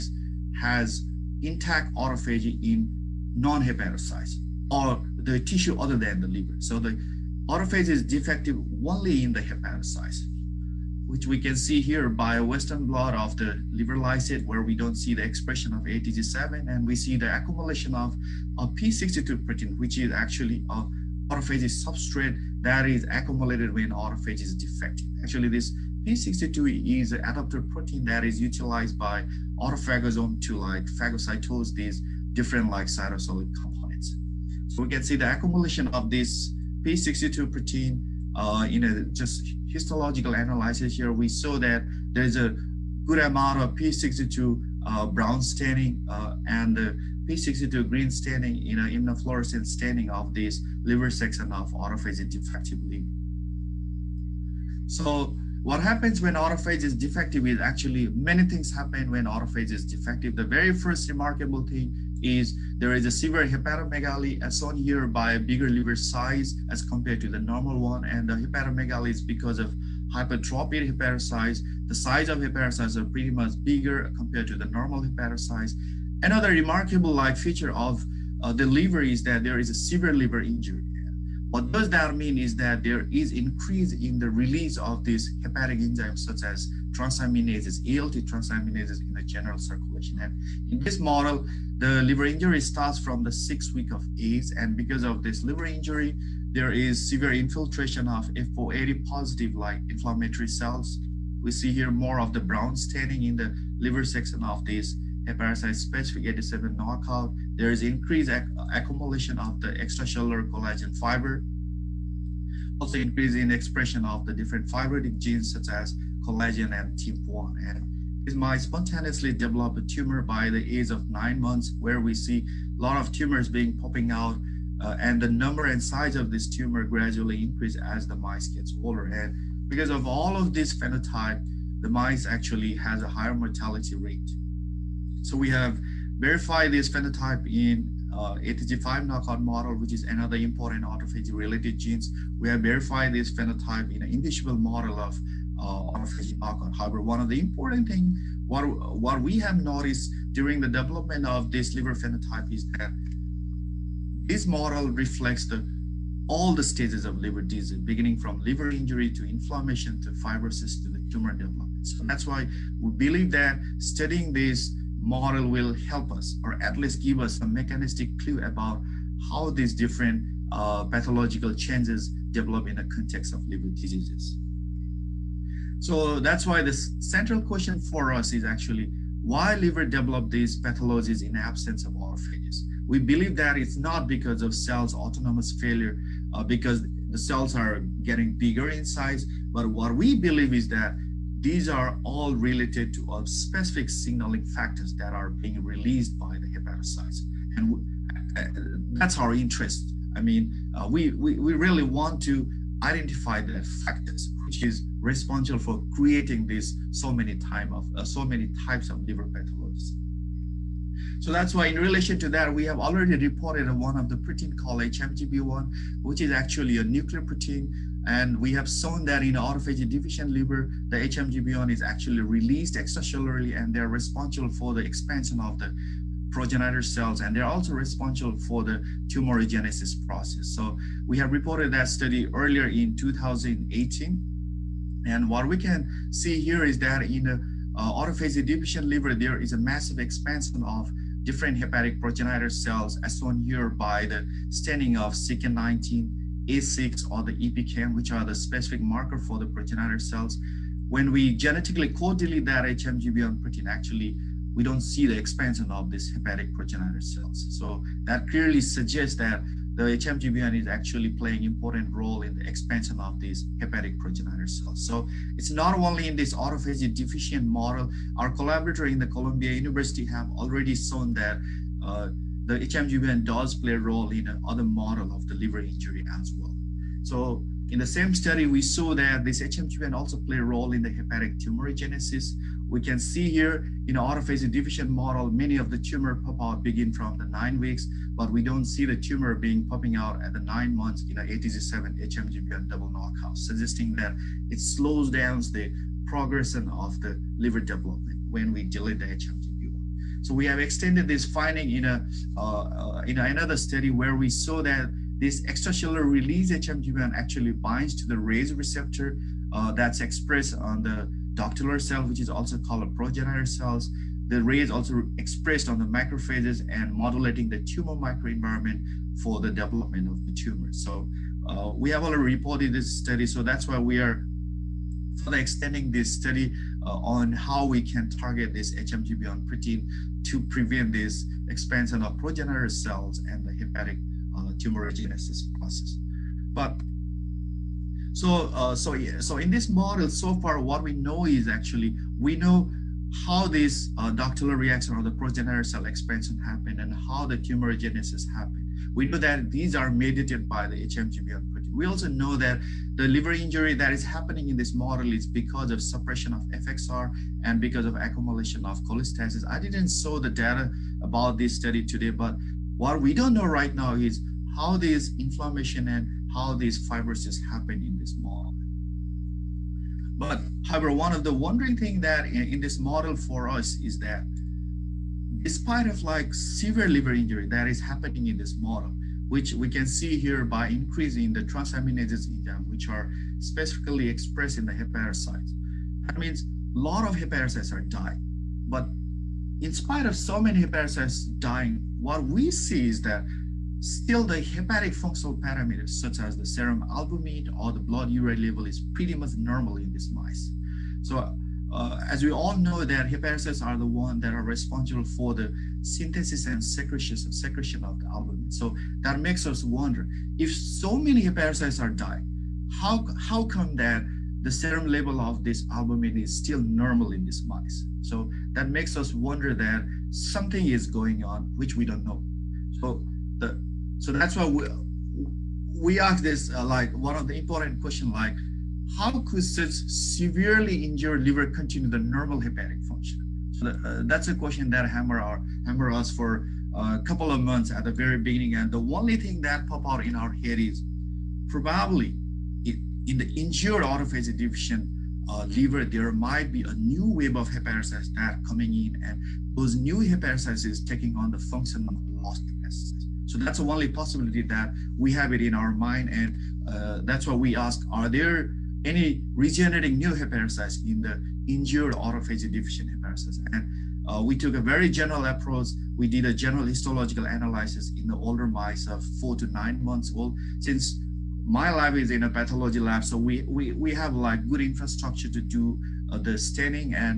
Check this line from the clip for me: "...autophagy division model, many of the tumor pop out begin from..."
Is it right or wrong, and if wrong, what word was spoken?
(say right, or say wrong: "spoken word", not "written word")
right.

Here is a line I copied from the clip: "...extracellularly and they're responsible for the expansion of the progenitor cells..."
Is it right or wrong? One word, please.
right.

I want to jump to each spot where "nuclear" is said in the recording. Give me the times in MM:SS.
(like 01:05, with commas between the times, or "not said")
03:36.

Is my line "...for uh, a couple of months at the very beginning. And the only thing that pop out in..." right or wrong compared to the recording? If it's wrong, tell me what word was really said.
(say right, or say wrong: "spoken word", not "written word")
right.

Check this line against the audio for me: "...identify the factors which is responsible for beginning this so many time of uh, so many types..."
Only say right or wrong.
wrong.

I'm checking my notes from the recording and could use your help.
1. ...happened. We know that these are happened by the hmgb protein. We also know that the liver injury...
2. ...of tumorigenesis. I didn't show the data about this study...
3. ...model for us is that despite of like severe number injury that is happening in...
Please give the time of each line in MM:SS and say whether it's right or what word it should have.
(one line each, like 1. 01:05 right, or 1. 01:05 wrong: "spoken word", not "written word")
1. 05:48 wrong: "mediated", not "happened"
2. 05:58 wrong: "cholestasis", not "tumorigenesis"
3. 06:12 wrong: "liver", not "number".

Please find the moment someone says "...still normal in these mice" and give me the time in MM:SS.
06:56.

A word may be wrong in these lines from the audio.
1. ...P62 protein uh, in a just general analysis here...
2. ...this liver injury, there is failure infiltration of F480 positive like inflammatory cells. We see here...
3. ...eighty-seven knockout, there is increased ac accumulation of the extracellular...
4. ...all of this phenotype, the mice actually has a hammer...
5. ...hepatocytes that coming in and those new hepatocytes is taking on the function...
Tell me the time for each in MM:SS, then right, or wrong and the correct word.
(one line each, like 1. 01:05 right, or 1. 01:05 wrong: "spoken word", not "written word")
1. 00:36 wrong: "histological", not "general"
2. 01:35 wrong: "severe", not "failure"
3. 01:46 right
4. 02:10 wrong: "higher", not "hammer"
5. 07:27 right.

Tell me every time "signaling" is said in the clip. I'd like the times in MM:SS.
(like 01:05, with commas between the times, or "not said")
03:13.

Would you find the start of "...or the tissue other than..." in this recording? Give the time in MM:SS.
00:04.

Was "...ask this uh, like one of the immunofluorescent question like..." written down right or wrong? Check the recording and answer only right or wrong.
wrong.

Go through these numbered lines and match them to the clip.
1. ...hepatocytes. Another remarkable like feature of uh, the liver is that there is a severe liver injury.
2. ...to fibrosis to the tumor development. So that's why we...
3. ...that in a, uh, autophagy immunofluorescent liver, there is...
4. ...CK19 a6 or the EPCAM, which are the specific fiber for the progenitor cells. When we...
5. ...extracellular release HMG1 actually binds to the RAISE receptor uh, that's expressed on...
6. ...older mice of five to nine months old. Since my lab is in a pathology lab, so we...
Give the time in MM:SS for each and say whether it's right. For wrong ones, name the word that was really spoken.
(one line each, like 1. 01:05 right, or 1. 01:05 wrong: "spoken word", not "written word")
1. 01:15 right
2. 02:40 right
3. 03:56 wrong: "deficient", not "immunofluorescent"
4. 04:05 wrong: "marker", not "fiber"
5. 05:05 right
6. 07:48 wrong: "four", not "five".